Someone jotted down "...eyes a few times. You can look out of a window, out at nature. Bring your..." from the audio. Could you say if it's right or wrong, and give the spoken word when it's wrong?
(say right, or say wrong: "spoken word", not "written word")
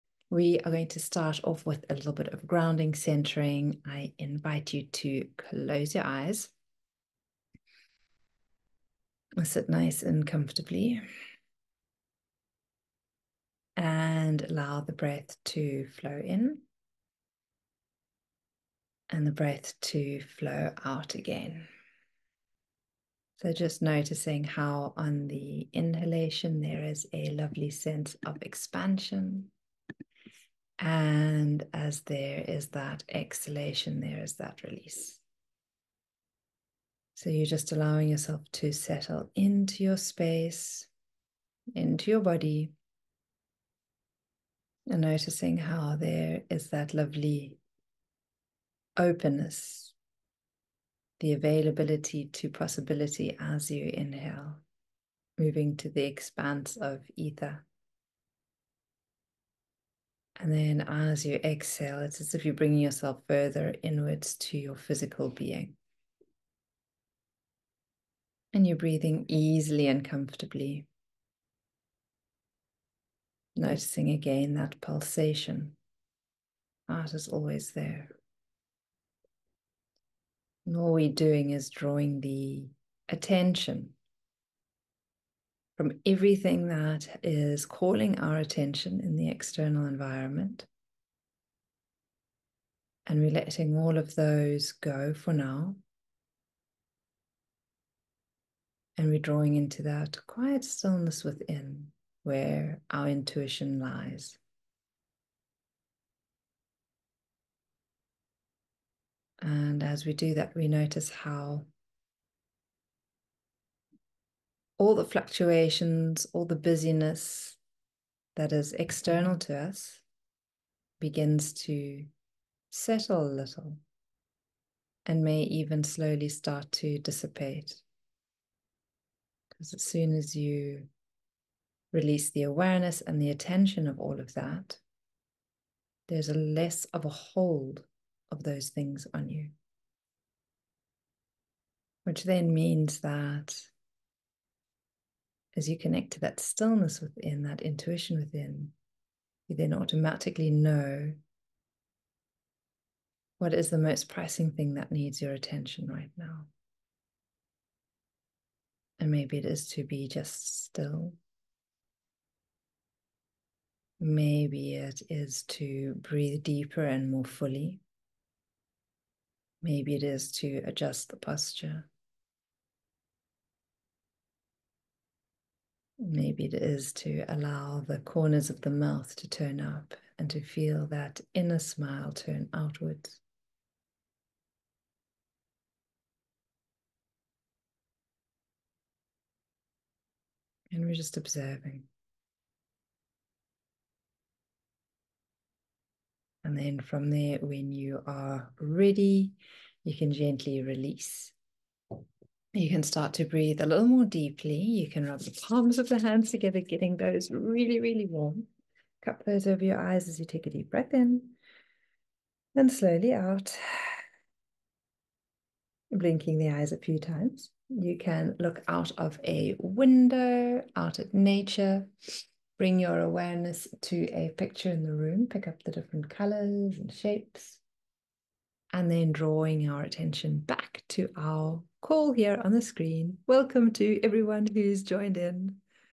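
right.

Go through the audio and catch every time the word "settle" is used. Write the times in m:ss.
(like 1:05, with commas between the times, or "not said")
0:38, 2:02.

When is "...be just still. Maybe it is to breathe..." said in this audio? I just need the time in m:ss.
2:39.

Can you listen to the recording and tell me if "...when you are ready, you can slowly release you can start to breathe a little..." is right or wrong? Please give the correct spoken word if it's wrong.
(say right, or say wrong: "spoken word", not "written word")
wrong: "gently", not "slowly".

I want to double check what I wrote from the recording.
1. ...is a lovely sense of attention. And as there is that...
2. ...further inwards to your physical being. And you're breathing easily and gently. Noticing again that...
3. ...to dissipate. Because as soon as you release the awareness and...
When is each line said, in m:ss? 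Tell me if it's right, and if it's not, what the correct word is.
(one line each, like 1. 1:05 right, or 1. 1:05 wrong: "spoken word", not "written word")
1. 0:26 wrong: "expansion", not "attention"
2. 1:03 wrong: "comfortably", not "gently"
3. 2:06 right.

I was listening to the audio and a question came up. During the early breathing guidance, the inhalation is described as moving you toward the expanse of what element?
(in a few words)
Ether.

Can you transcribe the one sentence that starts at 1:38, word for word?
And we're drawing into that quiet stillness within where our intuition lies.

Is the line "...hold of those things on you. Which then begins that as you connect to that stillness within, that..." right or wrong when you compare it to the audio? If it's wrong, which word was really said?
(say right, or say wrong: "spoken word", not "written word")
wrong: "means", not "begins".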